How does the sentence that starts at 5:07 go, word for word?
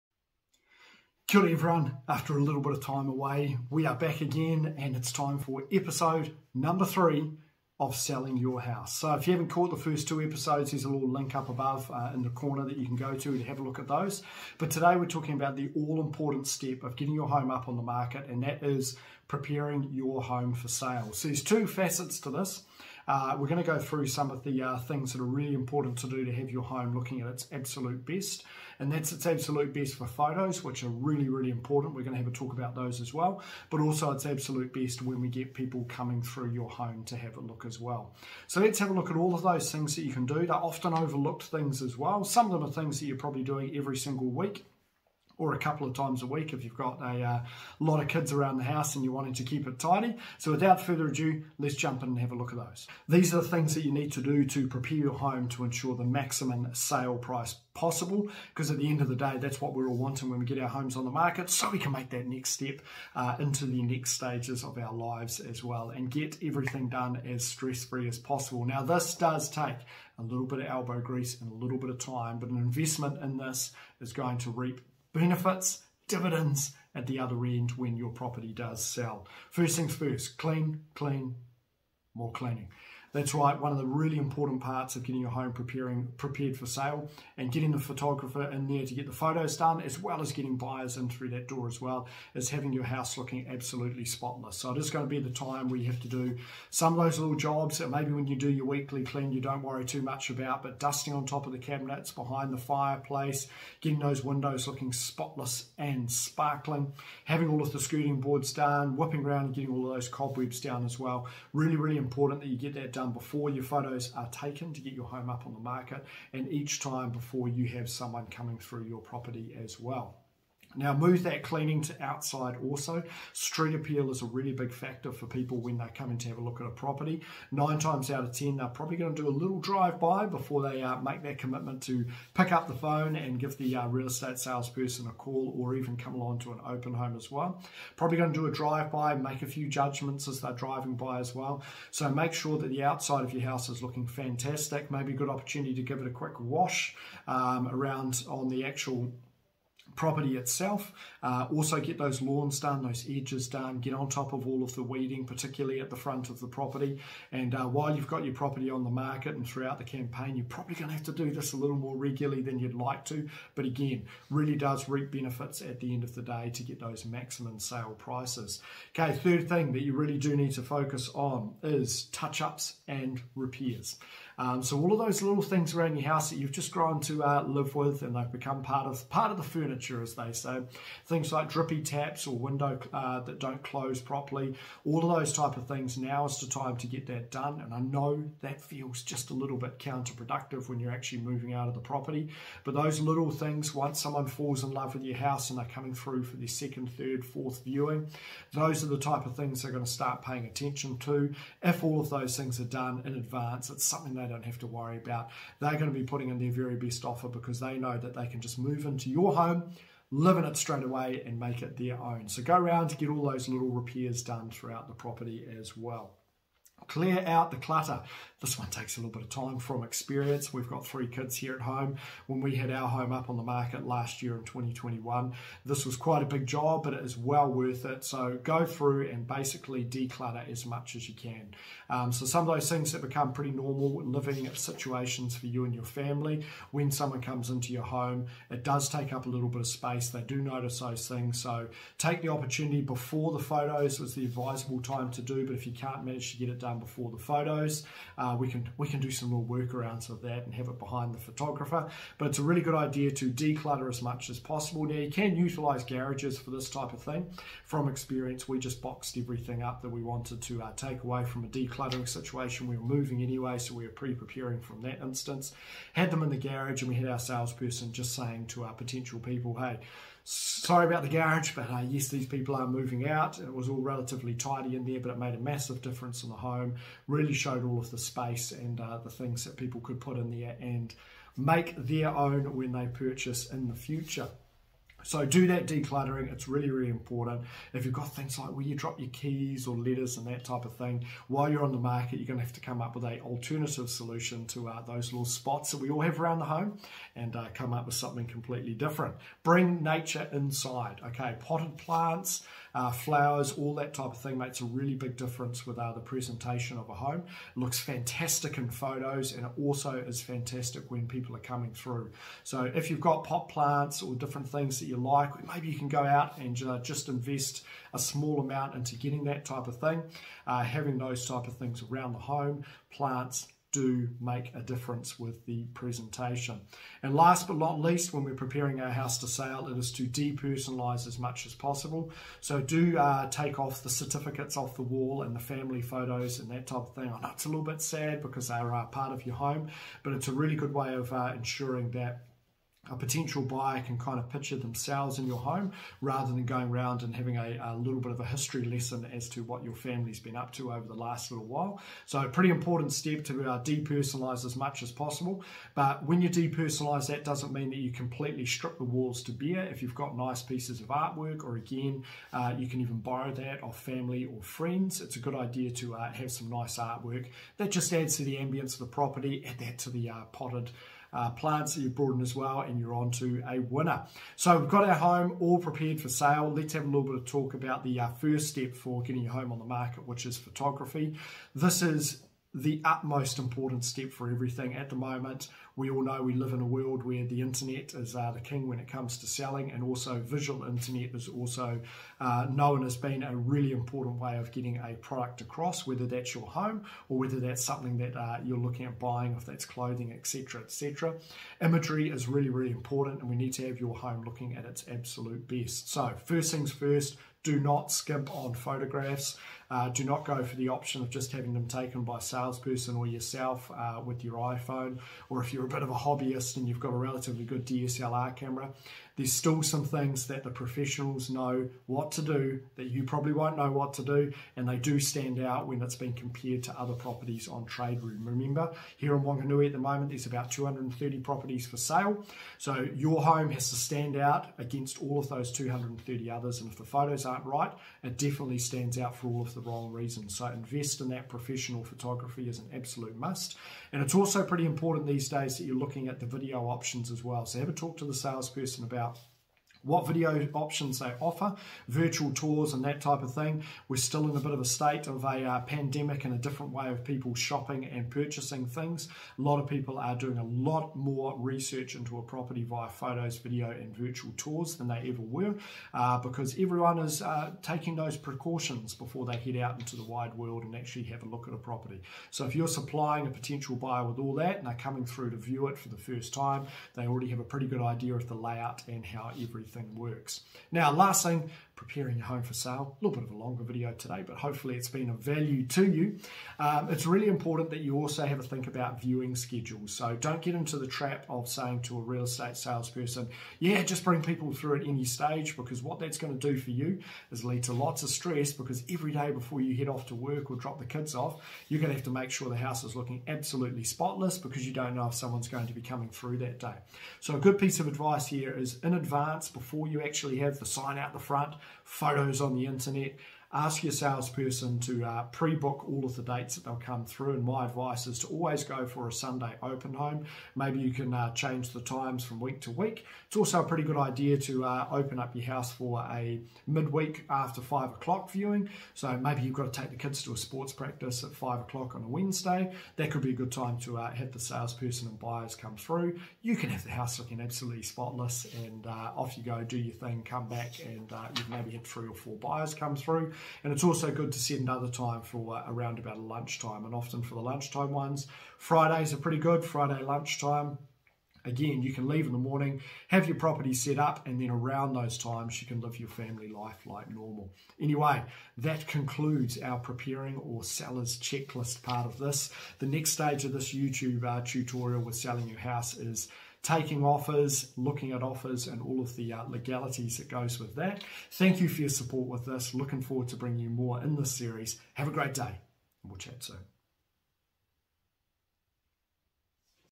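It looks fantastic in photos and it also is fantastic when people are coming through.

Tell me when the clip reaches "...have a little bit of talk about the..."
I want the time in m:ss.
6:16.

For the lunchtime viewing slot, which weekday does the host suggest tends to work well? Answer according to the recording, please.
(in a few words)
Friday.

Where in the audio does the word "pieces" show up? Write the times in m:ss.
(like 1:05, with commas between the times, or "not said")
6:00, 8:27.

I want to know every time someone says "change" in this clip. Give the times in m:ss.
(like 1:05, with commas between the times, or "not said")
8:41.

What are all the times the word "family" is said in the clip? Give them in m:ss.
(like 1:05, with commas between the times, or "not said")
3:55, 5:35, 5:49, 6:03, 9:16.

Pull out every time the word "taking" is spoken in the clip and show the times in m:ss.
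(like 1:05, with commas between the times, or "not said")
7:47, 9:26.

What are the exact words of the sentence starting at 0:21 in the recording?
So there's two facets to this.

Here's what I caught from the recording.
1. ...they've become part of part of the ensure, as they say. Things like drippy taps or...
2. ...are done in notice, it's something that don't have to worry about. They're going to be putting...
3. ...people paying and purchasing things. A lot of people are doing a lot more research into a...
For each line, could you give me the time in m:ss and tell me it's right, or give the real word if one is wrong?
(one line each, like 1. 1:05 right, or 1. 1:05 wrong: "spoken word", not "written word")
1. 2:58 wrong: "furniture", not "ensure"
2. 3:22 wrong: "advance", not "notice"
3. 7:37 wrong: "shopping", not "paying".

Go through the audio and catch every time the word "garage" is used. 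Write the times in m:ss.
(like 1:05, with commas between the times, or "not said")
4:15, 4:26, 4:31.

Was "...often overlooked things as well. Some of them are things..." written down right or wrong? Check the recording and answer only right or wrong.
right.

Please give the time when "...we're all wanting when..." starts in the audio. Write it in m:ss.
0:59.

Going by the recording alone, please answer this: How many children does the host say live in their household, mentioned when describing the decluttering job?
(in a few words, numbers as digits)
3.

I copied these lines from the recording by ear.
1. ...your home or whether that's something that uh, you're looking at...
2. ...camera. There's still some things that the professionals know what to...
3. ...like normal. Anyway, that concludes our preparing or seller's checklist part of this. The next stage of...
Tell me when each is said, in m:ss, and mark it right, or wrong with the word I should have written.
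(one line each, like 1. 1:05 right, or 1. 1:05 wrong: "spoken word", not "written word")
1. 6:36 right
2. 6:58 right
3. 9:16 right.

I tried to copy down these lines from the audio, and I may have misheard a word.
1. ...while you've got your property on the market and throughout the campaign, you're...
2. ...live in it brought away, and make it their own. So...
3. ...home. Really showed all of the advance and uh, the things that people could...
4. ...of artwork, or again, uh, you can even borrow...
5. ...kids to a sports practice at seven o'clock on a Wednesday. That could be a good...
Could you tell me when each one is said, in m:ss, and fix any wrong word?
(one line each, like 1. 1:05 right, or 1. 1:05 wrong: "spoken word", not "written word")
1. 2:37 right
2. 3:30 wrong: "straight", not "brought"
3. 4:36 wrong: "space", not "advance"
4. 6:00 right
5. 8:49 wrong: "five", not "seven".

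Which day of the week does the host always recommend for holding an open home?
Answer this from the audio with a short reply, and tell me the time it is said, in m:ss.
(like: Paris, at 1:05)
Sunday, at 8:39.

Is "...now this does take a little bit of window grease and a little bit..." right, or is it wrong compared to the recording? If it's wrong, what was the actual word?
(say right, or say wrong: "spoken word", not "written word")
wrong: "elbow", not "window".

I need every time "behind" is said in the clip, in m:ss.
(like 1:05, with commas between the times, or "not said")
1:42, 4:10.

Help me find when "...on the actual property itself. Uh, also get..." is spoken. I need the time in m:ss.
2:28.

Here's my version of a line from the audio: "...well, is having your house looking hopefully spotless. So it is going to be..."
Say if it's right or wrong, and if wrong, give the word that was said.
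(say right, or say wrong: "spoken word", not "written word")
wrong: "absolutely", not "hopefully".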